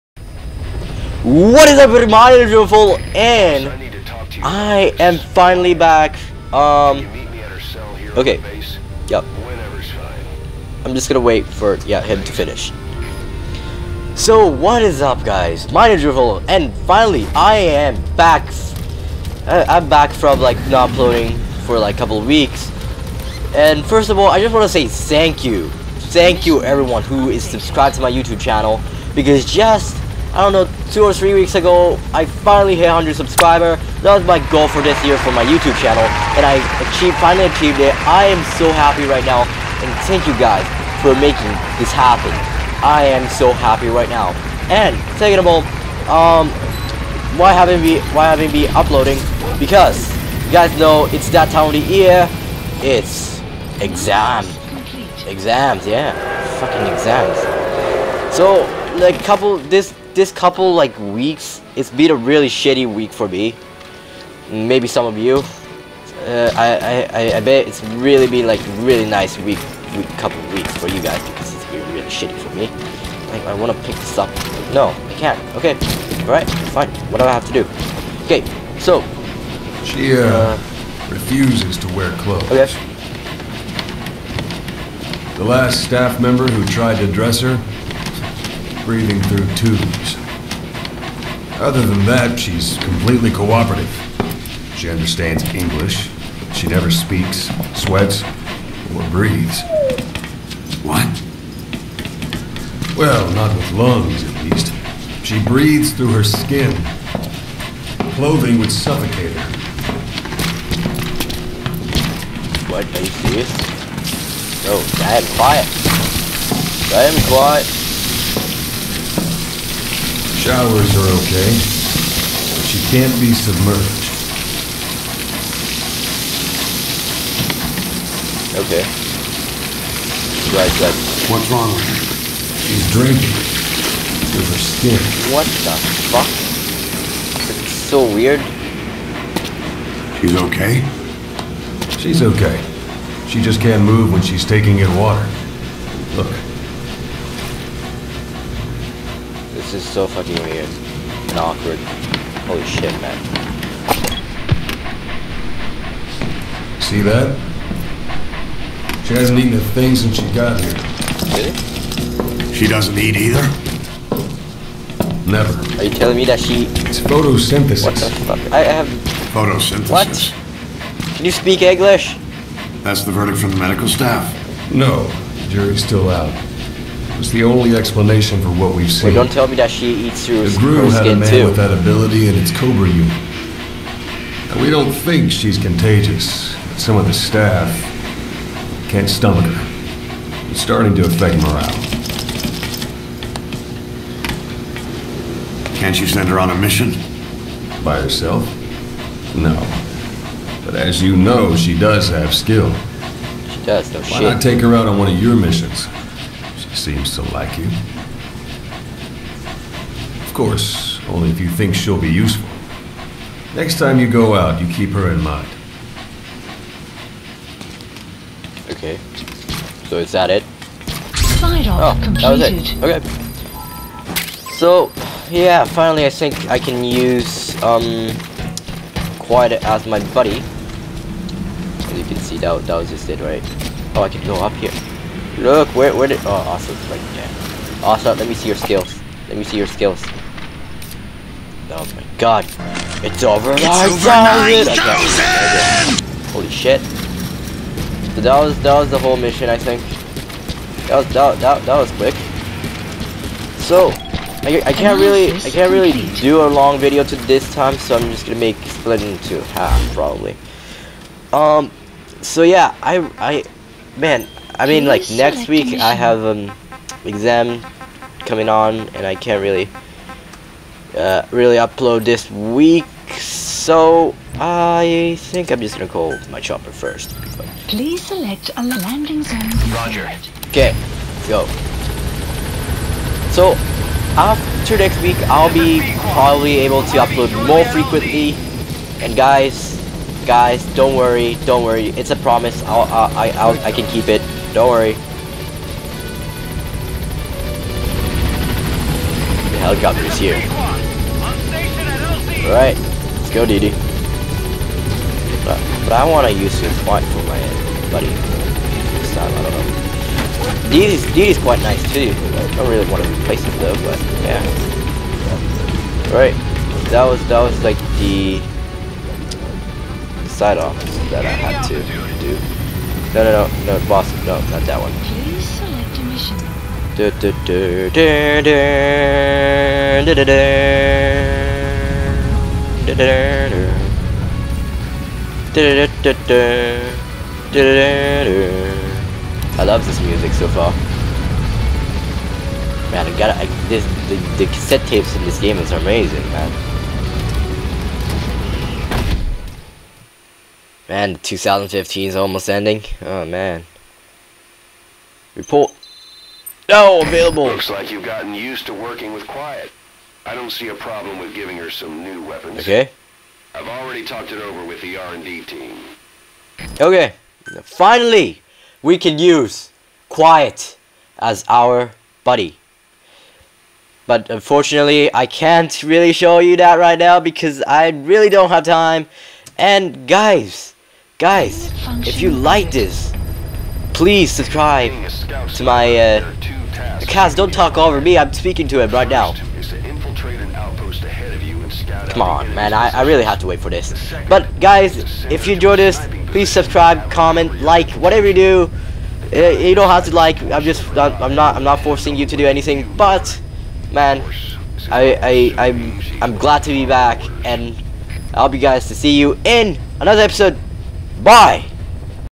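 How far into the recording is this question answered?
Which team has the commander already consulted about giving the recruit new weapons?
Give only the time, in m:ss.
6:04.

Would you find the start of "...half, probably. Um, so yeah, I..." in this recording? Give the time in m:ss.
4:19.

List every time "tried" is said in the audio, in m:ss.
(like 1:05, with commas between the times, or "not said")
1:26.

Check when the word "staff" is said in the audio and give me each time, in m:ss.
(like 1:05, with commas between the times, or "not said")
1:25, 2:53, 3:07.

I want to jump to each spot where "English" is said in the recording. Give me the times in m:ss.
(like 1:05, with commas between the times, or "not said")
1:35, 2:51.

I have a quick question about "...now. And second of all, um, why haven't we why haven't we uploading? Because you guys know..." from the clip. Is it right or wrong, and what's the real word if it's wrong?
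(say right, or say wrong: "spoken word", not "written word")
right.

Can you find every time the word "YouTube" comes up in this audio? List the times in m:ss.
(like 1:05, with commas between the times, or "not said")
0:28, 0:35.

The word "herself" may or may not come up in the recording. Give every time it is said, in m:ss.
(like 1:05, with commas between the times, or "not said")
3:18.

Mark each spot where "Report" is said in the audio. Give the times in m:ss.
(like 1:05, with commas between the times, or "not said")
5:55.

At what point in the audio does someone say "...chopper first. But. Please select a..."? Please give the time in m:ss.
4:36.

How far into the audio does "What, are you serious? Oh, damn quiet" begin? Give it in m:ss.
1:52.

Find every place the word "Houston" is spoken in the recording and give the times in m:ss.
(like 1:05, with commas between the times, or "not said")
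not said.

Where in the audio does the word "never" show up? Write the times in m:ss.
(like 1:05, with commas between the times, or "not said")
1:36, 2:45.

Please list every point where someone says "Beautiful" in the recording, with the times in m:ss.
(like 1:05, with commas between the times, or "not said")
0:02, 0:16.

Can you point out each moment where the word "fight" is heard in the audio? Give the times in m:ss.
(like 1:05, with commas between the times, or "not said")
5:06.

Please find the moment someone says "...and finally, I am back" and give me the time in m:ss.
0:16.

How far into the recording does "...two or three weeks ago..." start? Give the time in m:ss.
0:30.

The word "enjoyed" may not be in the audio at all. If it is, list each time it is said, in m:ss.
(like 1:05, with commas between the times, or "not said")
6:35.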